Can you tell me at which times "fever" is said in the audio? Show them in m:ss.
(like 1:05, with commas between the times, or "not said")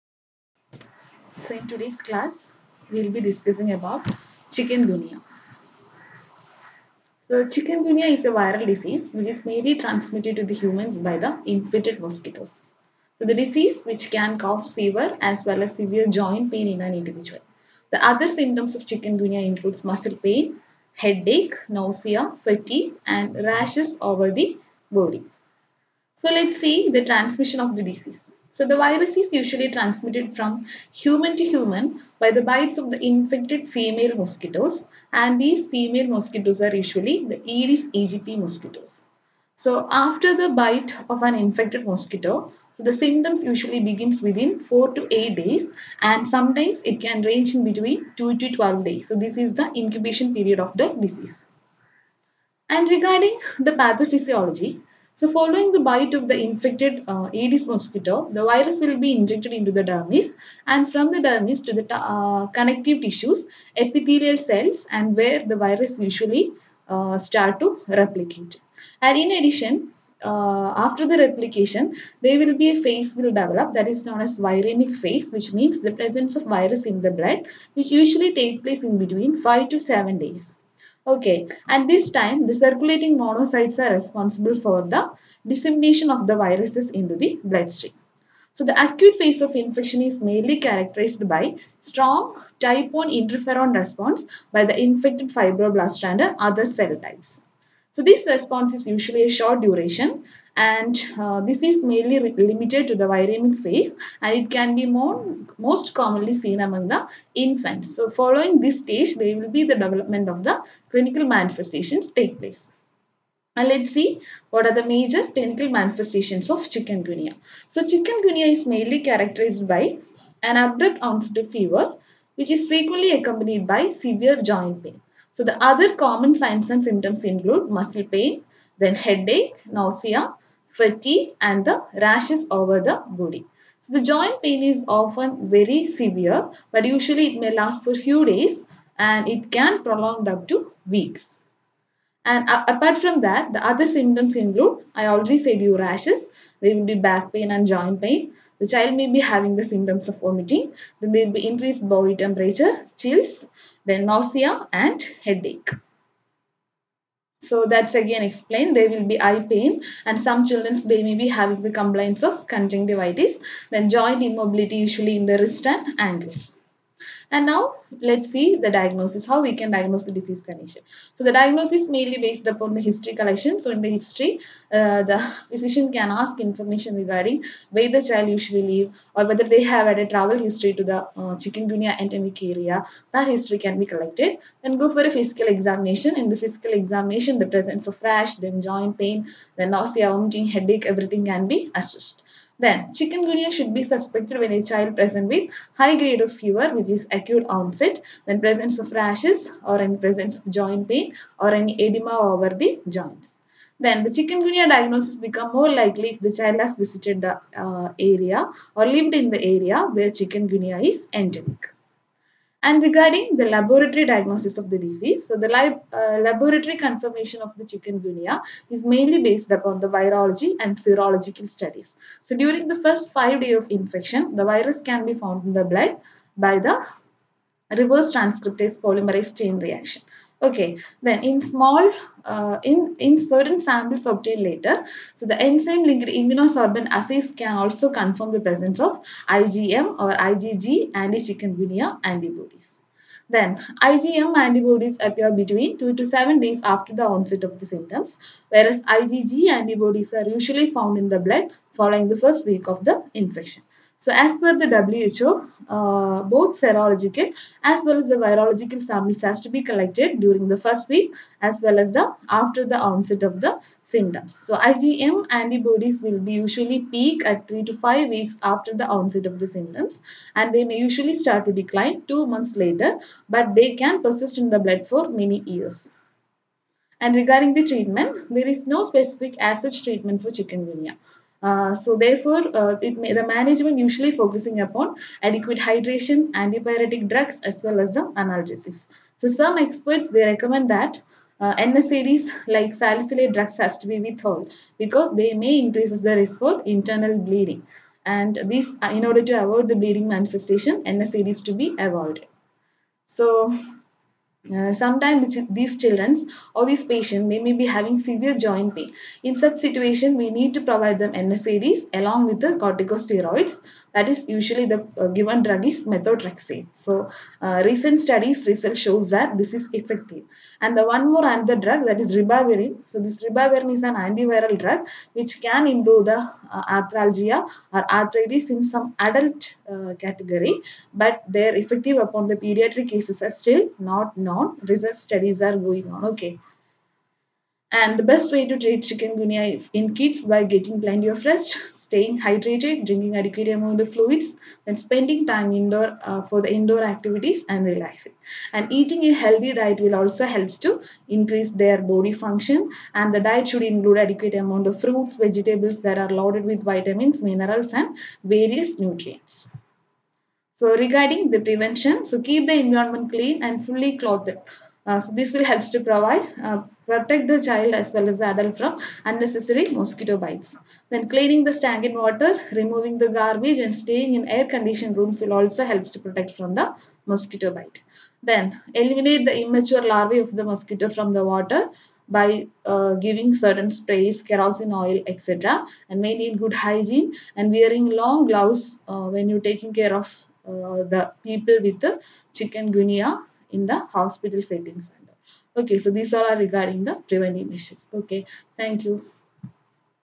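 0:14, 2:01, 3:16.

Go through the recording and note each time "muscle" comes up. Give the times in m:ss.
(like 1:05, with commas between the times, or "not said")
0:19, 2:07.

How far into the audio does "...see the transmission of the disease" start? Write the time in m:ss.
0:26.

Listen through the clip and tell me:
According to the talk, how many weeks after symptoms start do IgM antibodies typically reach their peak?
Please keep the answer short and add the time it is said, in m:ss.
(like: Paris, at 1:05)
3 to 5 weeks, at 4:27.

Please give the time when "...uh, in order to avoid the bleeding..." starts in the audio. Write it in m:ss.
4:58.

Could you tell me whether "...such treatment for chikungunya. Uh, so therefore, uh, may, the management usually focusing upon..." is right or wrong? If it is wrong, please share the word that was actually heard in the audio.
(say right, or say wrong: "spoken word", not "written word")
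right.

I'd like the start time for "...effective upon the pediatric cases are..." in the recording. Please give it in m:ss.
5:31.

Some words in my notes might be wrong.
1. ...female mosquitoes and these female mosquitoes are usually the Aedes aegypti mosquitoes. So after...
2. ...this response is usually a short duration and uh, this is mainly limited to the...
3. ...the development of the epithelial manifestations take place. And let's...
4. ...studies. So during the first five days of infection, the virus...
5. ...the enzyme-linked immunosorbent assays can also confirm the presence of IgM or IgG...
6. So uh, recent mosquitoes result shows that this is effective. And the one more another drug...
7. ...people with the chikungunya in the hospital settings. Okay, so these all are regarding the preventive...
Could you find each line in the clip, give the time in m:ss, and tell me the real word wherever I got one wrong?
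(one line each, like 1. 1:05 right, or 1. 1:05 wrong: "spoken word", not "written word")
1. 0:33 right
2. 1:38 right
3. 1:49 wrong: "clinical", not "epithelial"
4. 3:41 right
5. 3:55 right
6. 5:16 wrong: "studies", not "mosquitoes"
7. 6:31 right.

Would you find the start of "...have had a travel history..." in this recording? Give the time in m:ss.
2:59.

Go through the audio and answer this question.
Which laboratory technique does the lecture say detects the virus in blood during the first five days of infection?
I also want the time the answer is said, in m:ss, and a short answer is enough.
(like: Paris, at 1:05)
reverse transcriptase polymerase chain reaction, at 3:47.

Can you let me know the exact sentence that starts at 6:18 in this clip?
Then eliminate the immature larvae of the mosquito from the water by uh, giving certain sprays, kerosene oil, etc.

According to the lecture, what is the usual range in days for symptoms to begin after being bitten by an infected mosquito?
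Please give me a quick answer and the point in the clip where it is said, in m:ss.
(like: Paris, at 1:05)
4 to 8 days, at 0:44.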